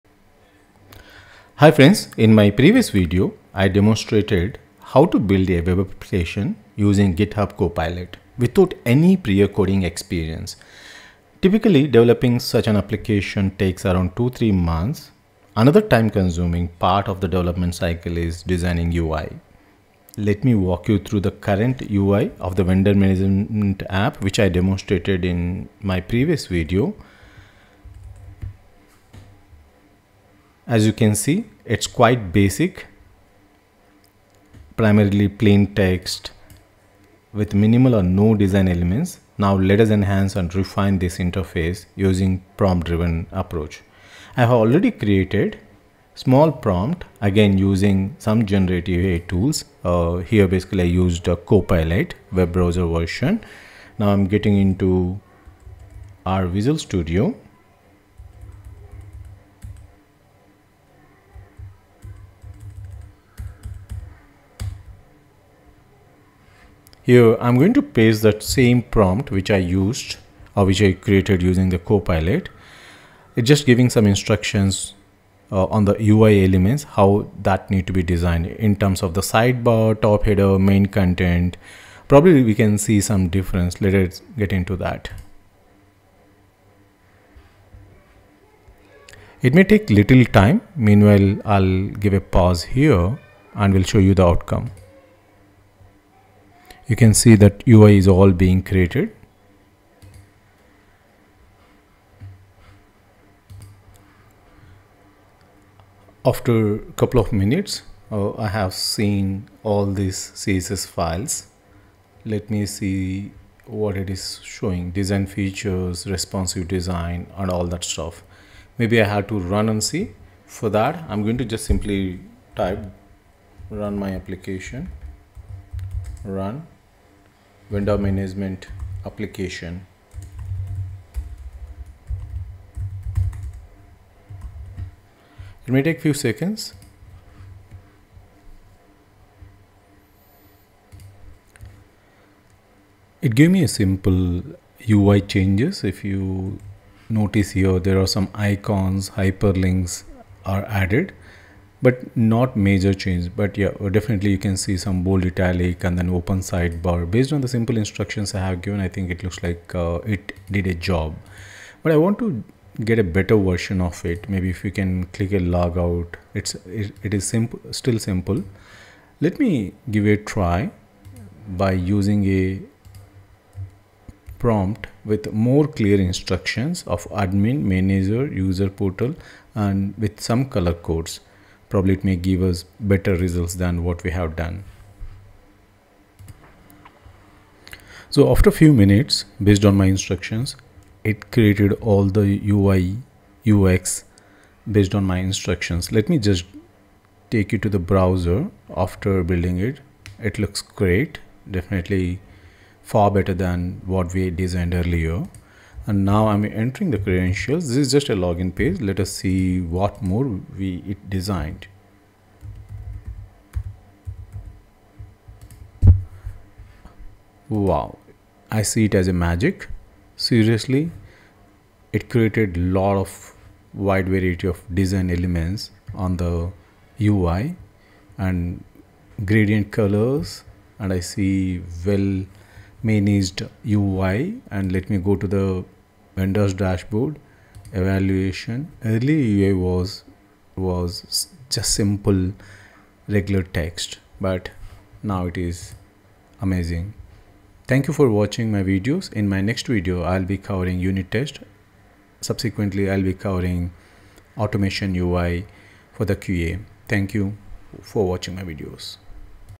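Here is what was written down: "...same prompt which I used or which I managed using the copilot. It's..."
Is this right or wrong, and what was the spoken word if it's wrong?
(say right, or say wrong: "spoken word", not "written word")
wrong: "created", not "managed".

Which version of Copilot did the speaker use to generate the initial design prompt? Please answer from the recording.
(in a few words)
web browser version.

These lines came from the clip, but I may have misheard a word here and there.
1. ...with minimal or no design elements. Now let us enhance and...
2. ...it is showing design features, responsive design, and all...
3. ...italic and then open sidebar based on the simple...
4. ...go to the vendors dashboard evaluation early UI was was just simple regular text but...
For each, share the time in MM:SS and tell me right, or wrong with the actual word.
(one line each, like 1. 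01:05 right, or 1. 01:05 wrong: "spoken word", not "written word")
1. 00:37 right
2. 01:53 right
3. 02:35 right
4. 03:54 right.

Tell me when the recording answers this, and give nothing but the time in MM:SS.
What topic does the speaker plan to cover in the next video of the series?
04:10.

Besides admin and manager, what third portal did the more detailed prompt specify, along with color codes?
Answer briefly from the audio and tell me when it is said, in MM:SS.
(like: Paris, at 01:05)
user portal, at 02:58.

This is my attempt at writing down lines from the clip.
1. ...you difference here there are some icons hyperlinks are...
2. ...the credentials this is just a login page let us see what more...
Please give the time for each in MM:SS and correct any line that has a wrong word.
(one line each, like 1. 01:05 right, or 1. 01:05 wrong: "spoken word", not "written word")
1. 02:26 wrong: "notice", not "difference"
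2. 03:26 right.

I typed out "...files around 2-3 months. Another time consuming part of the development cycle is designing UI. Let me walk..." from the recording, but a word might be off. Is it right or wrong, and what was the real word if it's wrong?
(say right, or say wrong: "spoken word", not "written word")
wrong: "takes", not "files".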